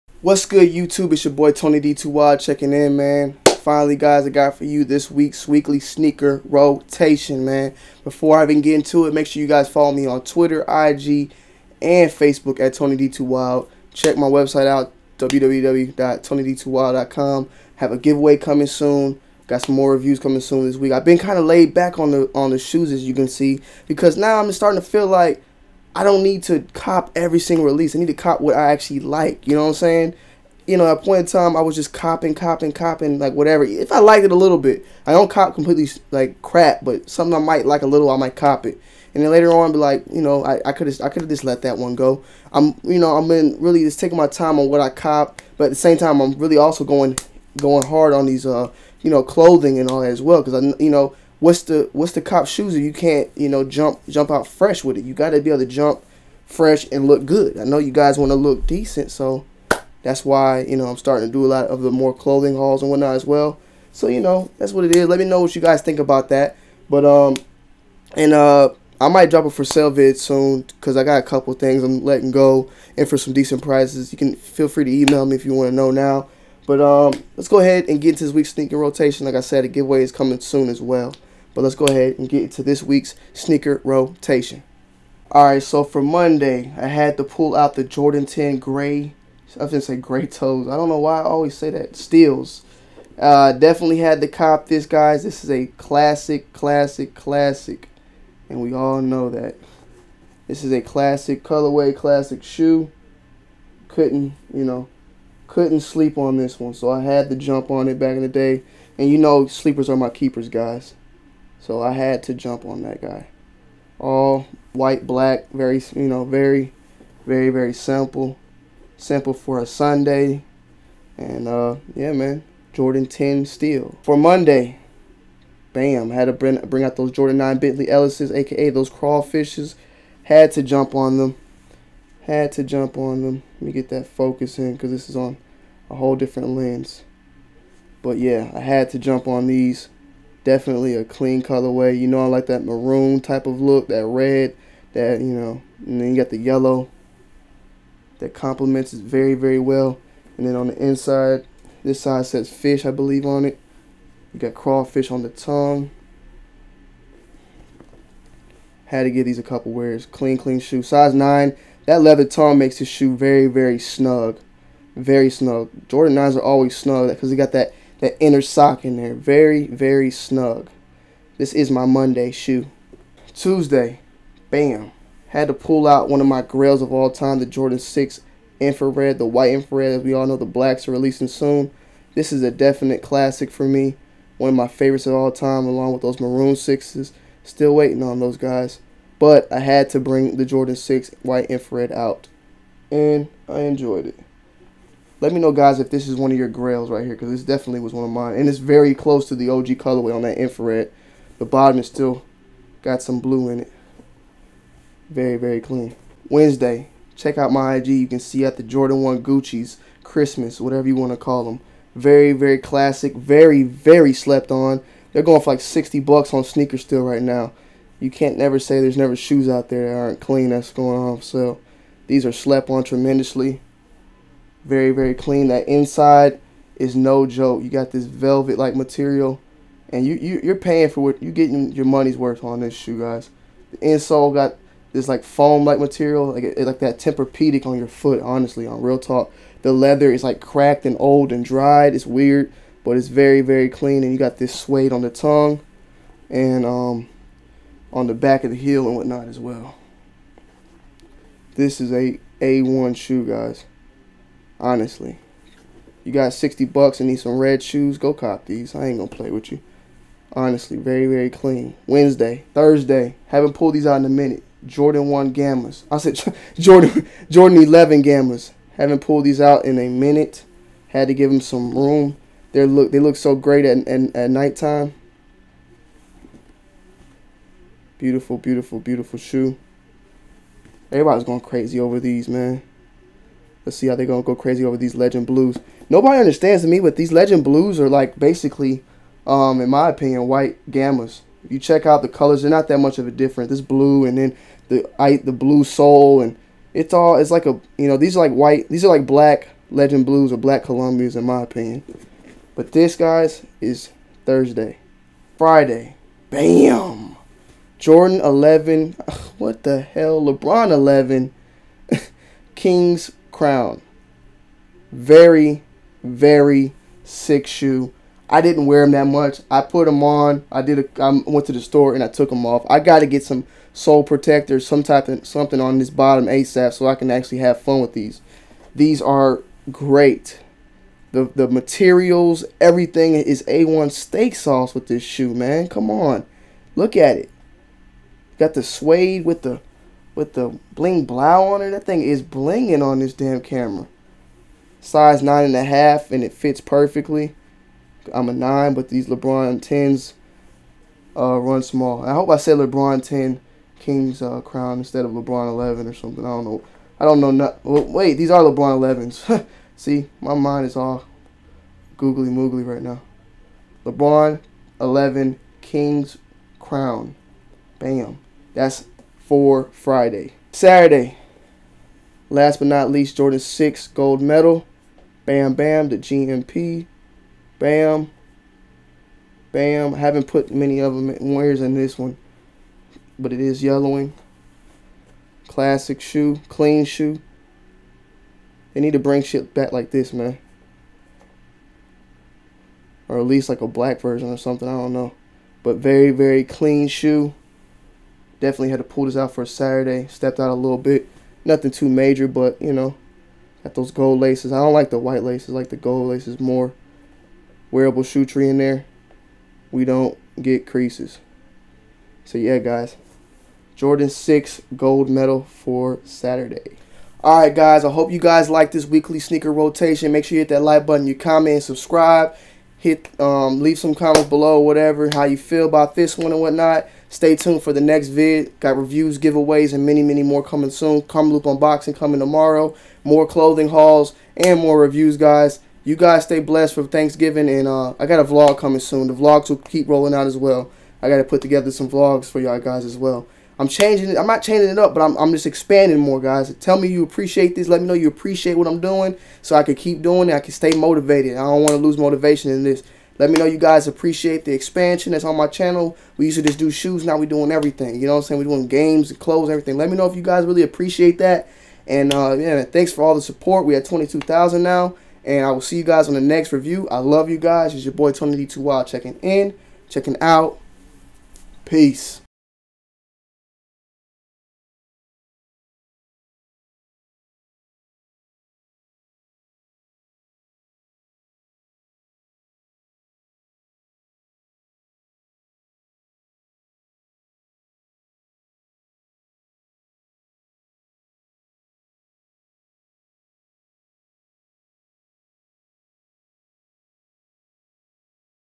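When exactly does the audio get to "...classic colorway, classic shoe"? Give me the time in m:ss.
1:40.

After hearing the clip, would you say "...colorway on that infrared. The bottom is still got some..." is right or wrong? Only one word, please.
right.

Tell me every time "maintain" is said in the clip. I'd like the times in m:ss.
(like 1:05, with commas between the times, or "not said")
not said.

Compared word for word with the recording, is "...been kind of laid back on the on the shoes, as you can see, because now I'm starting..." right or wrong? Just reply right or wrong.
right.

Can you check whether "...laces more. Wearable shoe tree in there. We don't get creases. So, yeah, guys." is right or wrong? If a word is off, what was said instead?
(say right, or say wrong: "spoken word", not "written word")
right.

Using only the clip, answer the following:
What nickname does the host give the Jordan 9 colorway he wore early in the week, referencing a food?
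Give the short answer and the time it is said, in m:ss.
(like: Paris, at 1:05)
crawfishes, at 2:08.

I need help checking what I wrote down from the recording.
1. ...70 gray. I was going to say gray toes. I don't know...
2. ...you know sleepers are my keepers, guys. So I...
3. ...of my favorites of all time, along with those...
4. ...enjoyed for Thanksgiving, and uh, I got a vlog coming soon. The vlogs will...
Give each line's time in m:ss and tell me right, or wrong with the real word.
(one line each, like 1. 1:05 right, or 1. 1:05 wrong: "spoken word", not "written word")
1. 1:28 wrong: "10", not "70"
2. 1:49 right
3. 3:04 right
4. 7:16 wrong: "blessed", not "enjoyed".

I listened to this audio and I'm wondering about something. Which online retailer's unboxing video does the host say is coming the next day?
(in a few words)
Karmaloop.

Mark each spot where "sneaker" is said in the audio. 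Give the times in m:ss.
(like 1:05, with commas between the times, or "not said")
0:05, 1:18, 1:23, 3:36, 6:59.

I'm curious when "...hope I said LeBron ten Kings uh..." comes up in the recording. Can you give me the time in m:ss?
5:52.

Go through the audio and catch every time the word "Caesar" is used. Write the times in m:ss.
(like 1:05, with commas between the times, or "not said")
not said.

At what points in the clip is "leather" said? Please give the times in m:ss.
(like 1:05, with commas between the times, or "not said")
2:42, 3:59.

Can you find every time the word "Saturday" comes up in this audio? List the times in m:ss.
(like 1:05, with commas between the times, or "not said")
6:10, 6:39, 6:56.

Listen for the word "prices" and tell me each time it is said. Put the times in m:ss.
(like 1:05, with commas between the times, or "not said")
1:13.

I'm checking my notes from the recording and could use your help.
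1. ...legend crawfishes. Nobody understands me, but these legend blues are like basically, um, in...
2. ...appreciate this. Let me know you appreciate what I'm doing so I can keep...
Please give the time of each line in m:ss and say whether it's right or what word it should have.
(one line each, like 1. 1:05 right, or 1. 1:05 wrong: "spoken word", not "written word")
1. 4:44 wrong: "blues", not "crawfishes"
2. 7:27 right.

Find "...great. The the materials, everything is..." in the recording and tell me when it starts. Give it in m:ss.
5:29.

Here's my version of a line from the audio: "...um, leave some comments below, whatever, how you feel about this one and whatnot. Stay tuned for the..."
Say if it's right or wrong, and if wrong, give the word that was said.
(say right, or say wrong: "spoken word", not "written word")
right.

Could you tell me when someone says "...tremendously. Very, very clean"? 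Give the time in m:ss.
3:42.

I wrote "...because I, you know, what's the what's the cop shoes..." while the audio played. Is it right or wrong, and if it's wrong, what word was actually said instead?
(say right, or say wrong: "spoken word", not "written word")
right.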